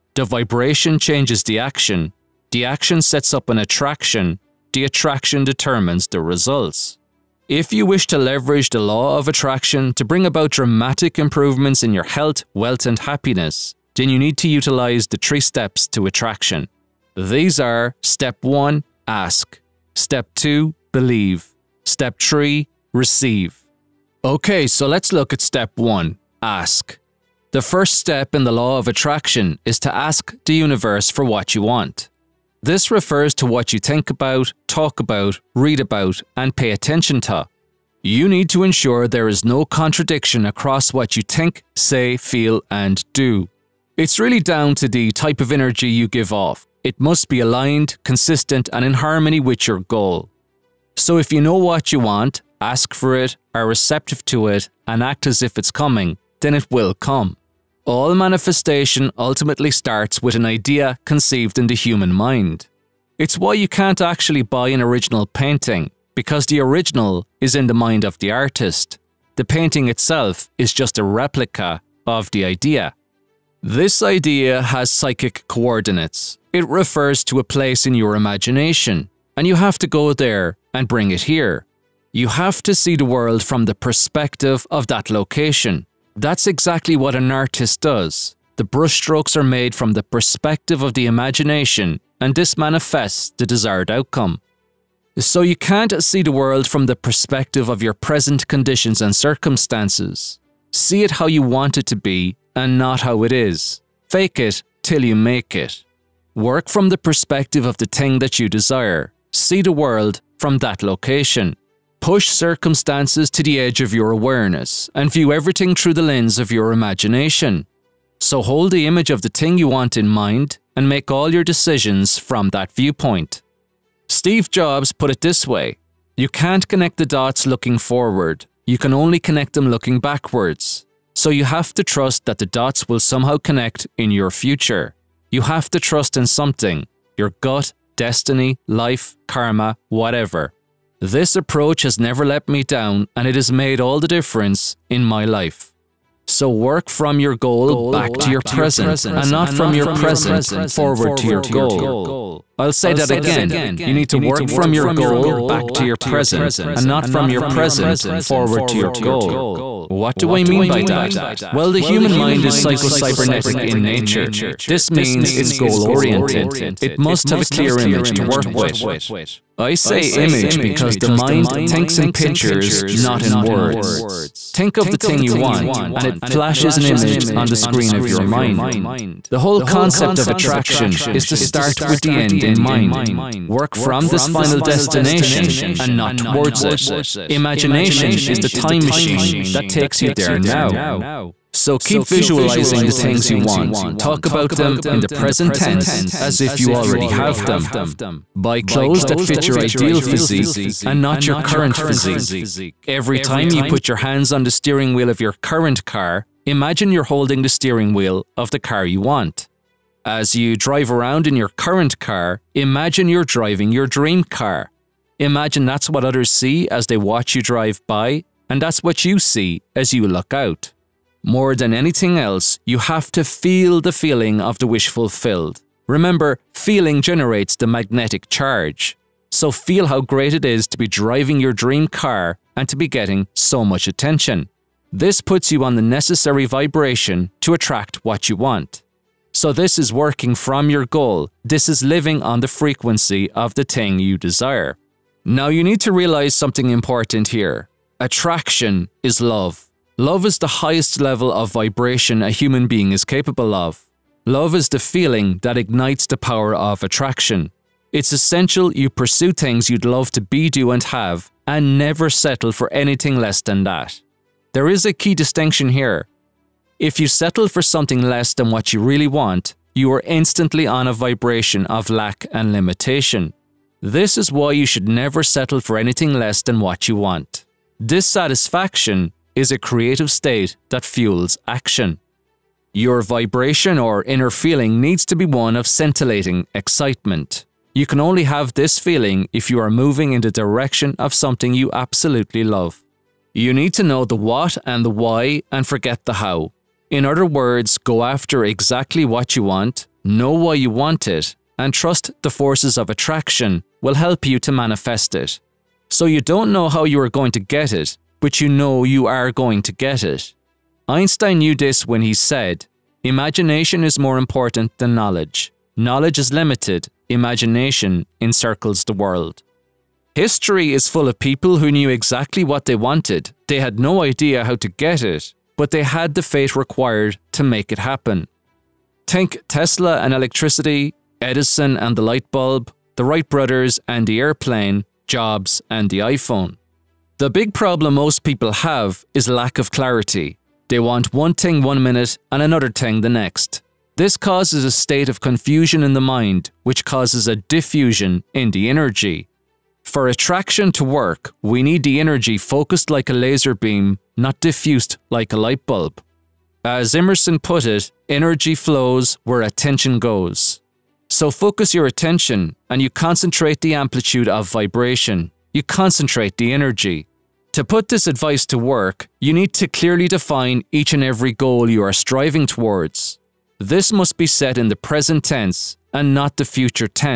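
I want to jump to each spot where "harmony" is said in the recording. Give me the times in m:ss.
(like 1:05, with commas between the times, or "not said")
0:48.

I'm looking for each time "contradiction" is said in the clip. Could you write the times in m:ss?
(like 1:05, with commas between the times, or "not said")
0:39.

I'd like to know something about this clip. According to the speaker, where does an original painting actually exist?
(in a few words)
In the mind of the artist.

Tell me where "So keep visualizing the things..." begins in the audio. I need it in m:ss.
3:11.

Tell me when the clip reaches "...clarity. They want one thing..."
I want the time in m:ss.
5:39.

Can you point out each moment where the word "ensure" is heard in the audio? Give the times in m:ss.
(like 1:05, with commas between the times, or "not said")
0:38.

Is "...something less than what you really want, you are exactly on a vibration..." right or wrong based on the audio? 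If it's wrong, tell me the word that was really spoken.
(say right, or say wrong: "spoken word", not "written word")
wrong: "instantly", not "exactly".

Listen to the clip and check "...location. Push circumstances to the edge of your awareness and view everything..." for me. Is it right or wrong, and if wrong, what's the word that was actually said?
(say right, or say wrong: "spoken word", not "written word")
right.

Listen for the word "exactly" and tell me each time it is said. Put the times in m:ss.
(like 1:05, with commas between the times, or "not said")
1:26, 4:58, 5:21.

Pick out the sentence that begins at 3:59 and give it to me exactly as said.
So, this is working from your goal.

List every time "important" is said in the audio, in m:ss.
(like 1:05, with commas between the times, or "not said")
4:06, 5:14.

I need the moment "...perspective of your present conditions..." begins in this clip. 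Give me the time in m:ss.
1:36.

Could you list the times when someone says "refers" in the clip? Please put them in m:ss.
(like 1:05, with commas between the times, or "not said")
0:32, 1:16.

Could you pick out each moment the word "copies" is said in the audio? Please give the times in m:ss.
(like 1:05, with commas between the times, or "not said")
not said.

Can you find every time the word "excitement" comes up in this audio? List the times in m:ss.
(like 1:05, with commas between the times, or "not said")
4:46.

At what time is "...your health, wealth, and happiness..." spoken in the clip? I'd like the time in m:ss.
0:11.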